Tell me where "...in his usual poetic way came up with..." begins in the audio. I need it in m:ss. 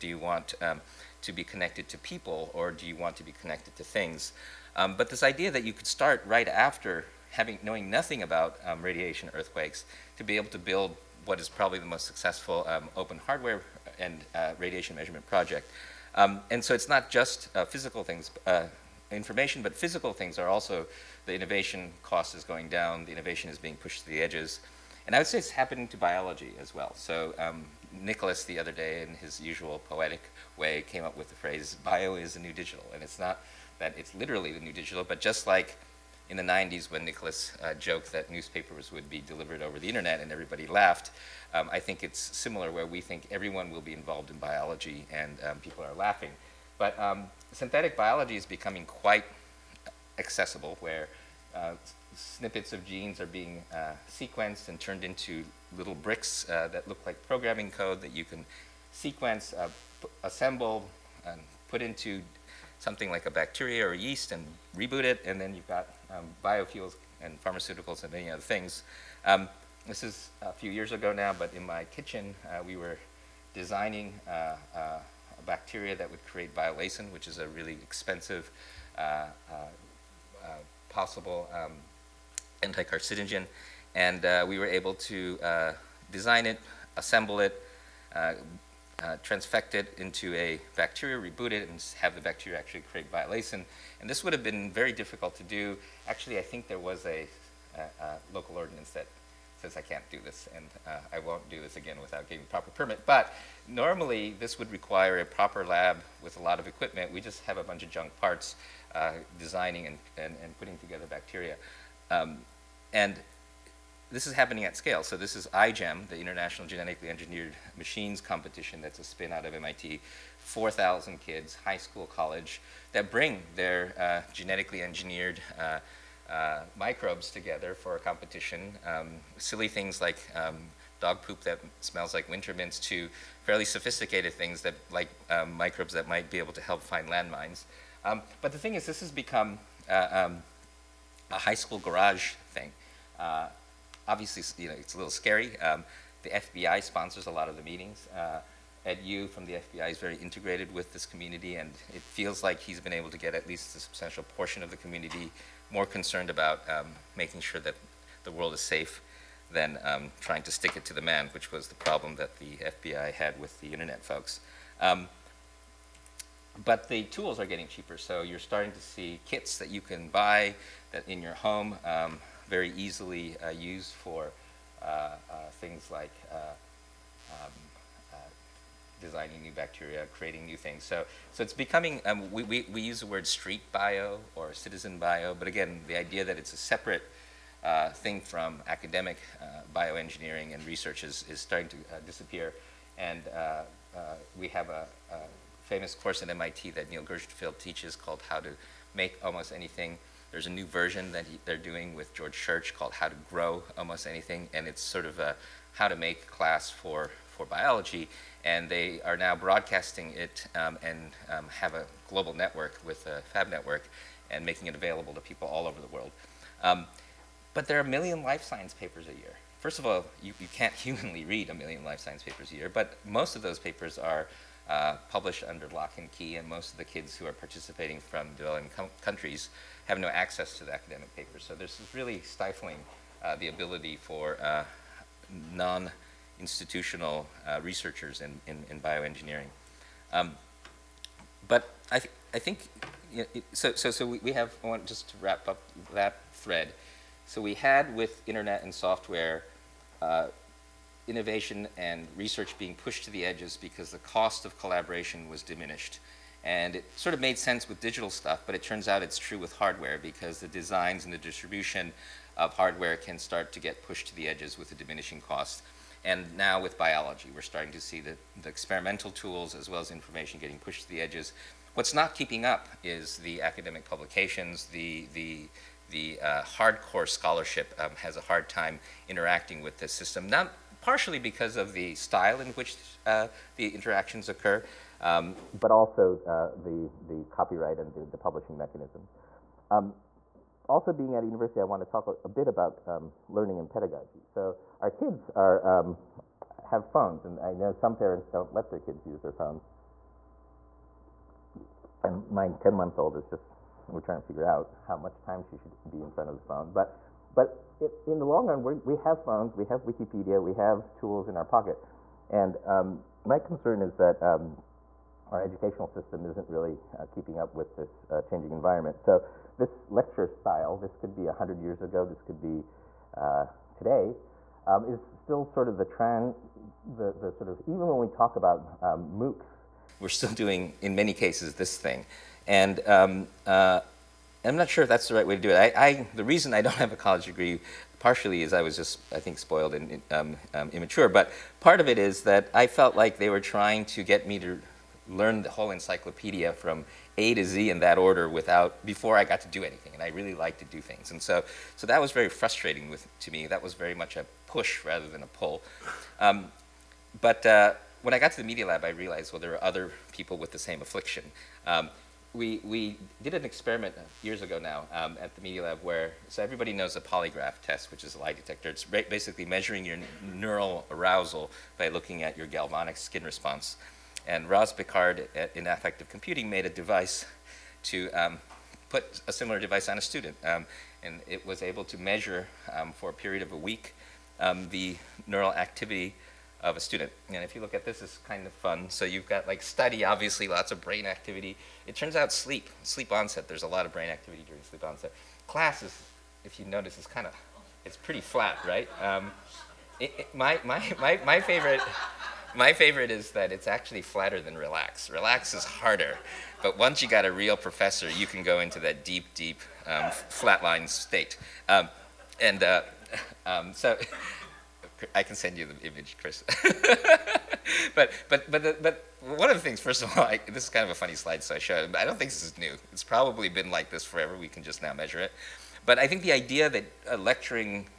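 0:29.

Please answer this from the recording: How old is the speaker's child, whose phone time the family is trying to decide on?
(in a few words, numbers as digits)
10 months.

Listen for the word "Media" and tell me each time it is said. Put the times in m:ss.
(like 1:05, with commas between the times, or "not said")
5:58, 6:05.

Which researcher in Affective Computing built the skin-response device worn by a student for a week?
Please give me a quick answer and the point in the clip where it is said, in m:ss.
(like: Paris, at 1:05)
Roz Picard, at 6:14.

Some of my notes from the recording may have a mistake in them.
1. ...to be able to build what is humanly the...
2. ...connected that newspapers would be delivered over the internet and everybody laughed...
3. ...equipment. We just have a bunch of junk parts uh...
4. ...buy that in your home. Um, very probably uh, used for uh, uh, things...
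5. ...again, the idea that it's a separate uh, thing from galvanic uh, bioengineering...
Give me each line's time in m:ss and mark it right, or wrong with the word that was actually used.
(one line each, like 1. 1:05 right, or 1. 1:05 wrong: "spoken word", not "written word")
1. 0:10 wrong: "probably", not "humanly"
2. 0:37 wrong: "joked", not "connected"
3. 1:46 right
4. 2:50 wrong: "easily", not "probably"
5. 3:05 wrong: "academic", not "galvanic".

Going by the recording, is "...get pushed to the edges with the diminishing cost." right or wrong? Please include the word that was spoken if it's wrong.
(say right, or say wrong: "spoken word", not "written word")
right.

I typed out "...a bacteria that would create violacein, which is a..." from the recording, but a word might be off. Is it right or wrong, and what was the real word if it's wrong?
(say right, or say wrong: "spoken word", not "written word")
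right.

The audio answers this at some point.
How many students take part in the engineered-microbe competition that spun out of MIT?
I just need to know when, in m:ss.
2:00.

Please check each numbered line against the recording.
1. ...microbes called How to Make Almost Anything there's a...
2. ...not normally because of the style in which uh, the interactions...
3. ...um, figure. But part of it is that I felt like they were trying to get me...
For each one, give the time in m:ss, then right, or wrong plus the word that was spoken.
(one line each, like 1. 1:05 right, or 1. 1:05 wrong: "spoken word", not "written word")
1. 3:17 wrong: "teaches", not "microbes"
2. 4:40 wrong: "partially", not "normally"
3. 5:40 wrong: "immature", not "figure".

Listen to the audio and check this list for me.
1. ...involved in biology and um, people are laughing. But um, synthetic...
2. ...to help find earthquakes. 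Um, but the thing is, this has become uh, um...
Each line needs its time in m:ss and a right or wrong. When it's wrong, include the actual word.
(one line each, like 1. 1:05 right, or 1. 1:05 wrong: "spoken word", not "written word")
1. 0:43 right
2. 2:16 wrong: "landmines", not "earthquakes".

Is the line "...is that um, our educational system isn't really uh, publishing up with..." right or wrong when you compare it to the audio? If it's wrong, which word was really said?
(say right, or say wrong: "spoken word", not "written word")
wrong: "keeping", not "publishing".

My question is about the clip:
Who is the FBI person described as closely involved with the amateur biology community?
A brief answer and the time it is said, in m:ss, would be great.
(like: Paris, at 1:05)
Ed You, at 2:28.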